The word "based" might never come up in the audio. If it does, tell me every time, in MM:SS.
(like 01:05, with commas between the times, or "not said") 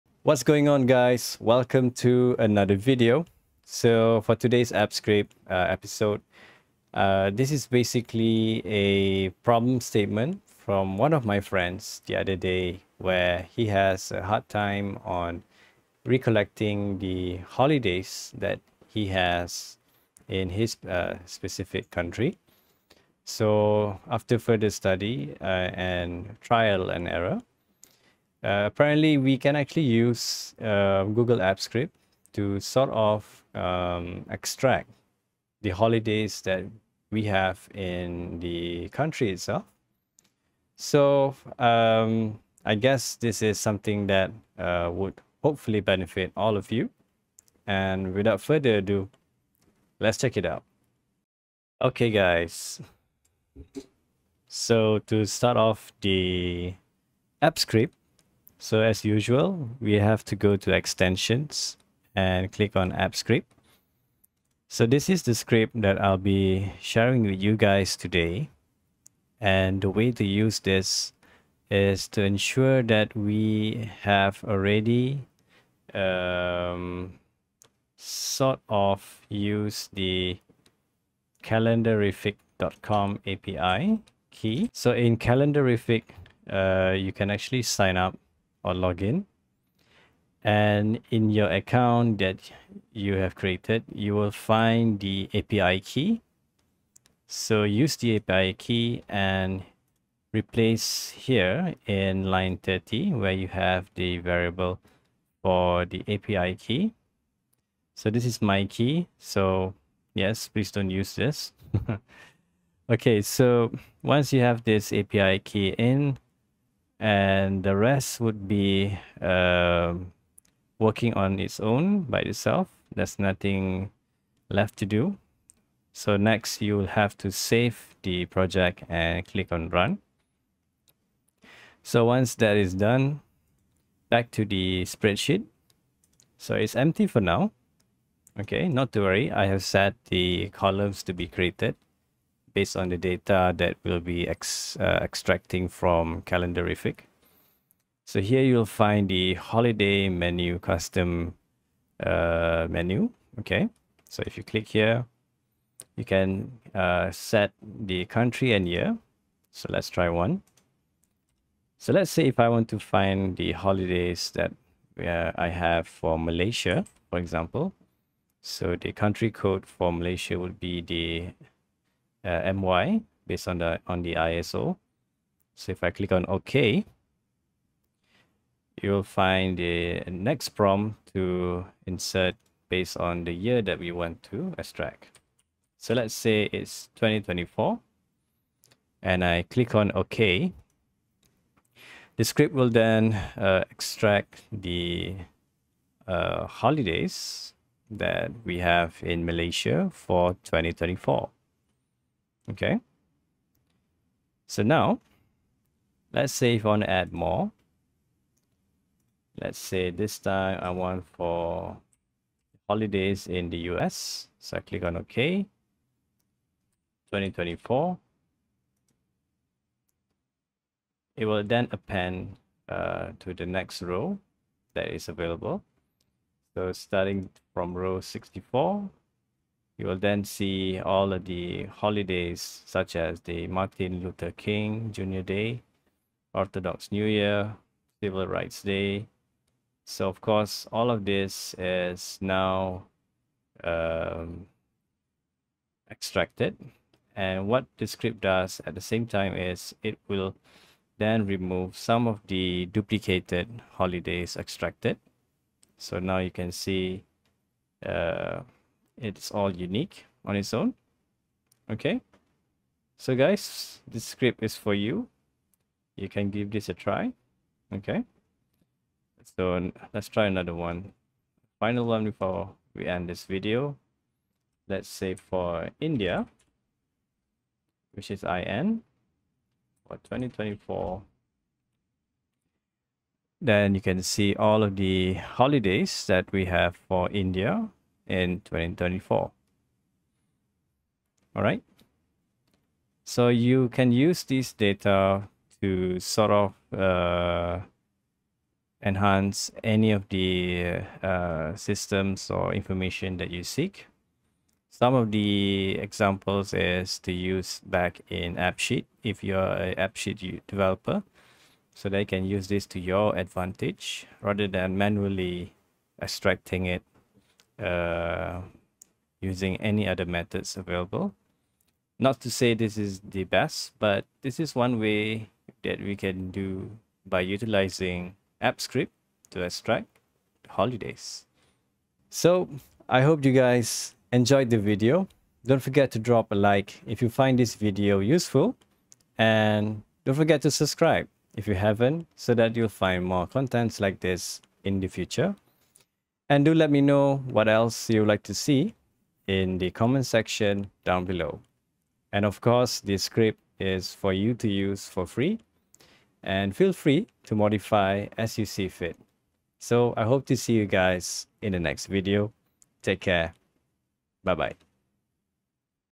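02:22, 02:53, 03:02.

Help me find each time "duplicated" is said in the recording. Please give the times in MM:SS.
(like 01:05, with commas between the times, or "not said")
04:12.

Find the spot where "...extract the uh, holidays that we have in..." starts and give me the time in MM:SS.
03:13.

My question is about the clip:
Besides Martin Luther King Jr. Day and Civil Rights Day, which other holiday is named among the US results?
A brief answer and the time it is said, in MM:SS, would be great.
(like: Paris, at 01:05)
Orthodox New Year, at 03:56.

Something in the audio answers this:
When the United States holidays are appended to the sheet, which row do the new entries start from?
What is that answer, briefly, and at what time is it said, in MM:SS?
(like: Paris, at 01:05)
64, at 03:47.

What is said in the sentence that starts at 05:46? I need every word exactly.
And do let me know what else you'd like to see in the comment section down below.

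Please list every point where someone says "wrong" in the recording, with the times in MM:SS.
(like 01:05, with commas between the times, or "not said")
not said.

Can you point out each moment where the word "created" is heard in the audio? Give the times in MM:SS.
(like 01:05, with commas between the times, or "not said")
01:33, 02:21.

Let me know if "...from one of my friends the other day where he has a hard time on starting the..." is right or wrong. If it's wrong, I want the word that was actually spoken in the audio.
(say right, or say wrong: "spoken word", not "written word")
wrong: "recollecting", not "starting".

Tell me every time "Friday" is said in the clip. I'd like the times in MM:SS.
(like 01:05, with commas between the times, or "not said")
not said.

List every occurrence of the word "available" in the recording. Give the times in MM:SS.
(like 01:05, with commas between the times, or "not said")
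03:45, 05:20.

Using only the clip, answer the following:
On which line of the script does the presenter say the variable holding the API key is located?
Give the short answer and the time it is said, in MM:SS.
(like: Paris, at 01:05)
30, at 01:42.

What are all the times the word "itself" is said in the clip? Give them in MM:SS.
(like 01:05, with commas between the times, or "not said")
00:39, 02:02.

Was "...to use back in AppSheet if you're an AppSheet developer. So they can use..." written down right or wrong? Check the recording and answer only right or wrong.
right.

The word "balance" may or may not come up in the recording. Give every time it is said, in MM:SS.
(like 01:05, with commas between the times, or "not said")
not said.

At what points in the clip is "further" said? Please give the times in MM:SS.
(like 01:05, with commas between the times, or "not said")
00:24, 00:48.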